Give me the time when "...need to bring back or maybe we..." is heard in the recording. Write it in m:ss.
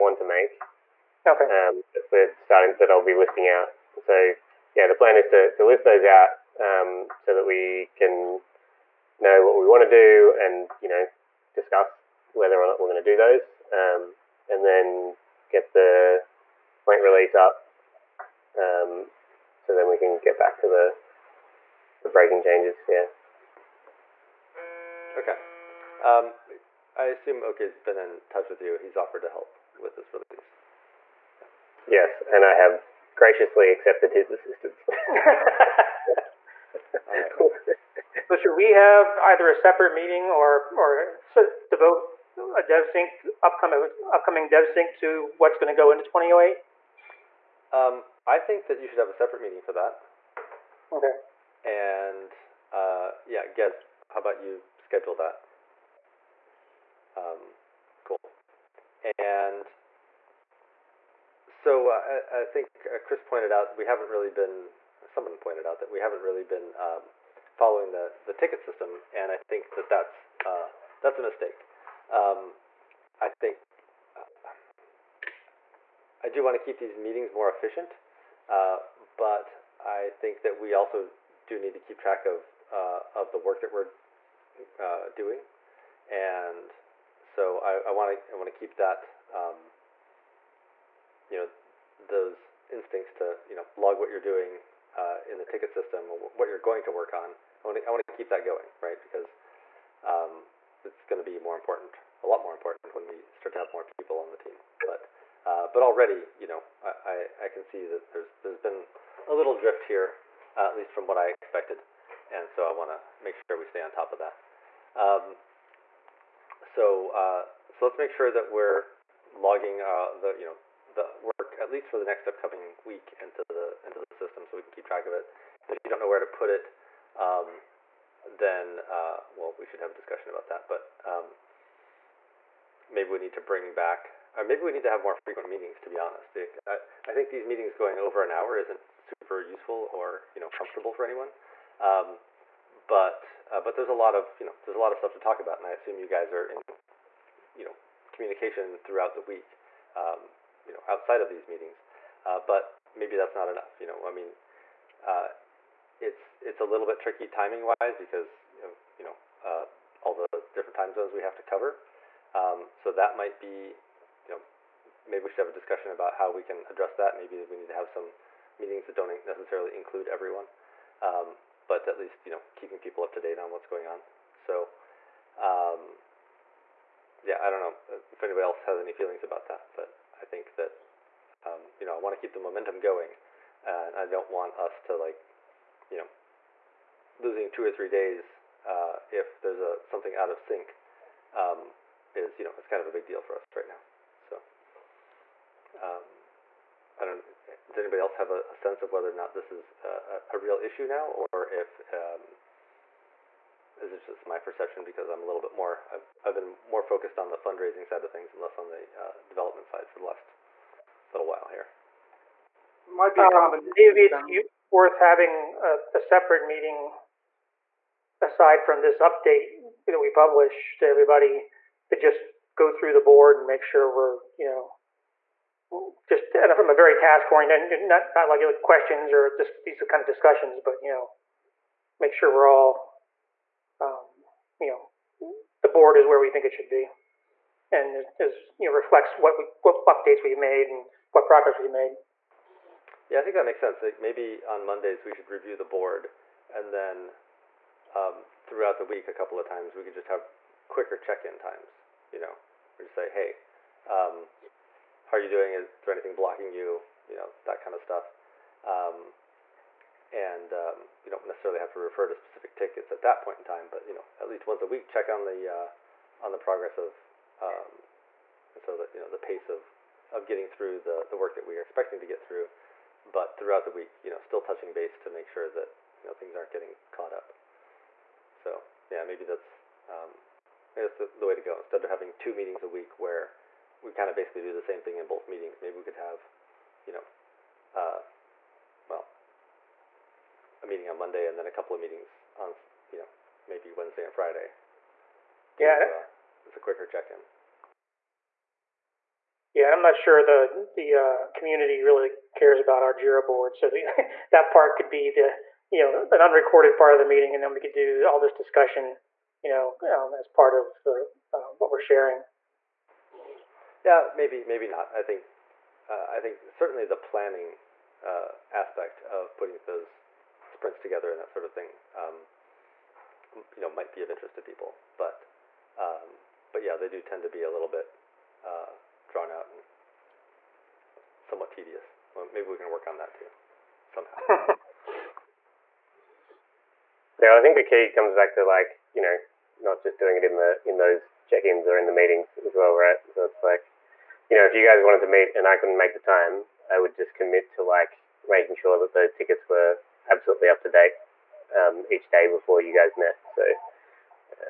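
2:13.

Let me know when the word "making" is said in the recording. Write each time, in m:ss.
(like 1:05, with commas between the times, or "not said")
5:48.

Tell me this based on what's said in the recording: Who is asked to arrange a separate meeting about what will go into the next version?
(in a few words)
Gez.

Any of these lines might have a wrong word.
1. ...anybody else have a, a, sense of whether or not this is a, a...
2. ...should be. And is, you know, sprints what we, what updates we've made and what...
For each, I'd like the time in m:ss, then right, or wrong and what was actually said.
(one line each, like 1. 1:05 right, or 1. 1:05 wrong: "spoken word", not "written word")
1. 3:17 right
2. 3:56 wrong: "reflects", not "sprints".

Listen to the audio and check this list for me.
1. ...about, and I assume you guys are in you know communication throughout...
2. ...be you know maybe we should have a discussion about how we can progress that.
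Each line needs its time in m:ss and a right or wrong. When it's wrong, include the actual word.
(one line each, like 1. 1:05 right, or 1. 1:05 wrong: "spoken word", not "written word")
1. 2:25 right
2. 2:43 wrong: "address", not "progress".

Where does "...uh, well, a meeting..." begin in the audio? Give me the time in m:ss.
4:47.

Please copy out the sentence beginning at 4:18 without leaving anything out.
Um, and um, you don't necessarily have to refer to specific tickets at that point in time.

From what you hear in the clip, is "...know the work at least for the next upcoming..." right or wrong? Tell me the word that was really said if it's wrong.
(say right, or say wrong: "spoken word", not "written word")
right.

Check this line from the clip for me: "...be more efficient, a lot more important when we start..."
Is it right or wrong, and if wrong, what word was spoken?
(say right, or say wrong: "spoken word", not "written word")
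wrong: "important", not "efficient".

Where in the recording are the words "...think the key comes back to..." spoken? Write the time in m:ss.
5:37.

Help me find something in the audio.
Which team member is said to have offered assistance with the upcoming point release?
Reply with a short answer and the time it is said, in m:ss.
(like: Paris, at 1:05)
Åke, at 0:27.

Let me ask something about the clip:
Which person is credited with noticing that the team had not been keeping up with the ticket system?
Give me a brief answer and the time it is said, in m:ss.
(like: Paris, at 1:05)
Chris, at 1:02.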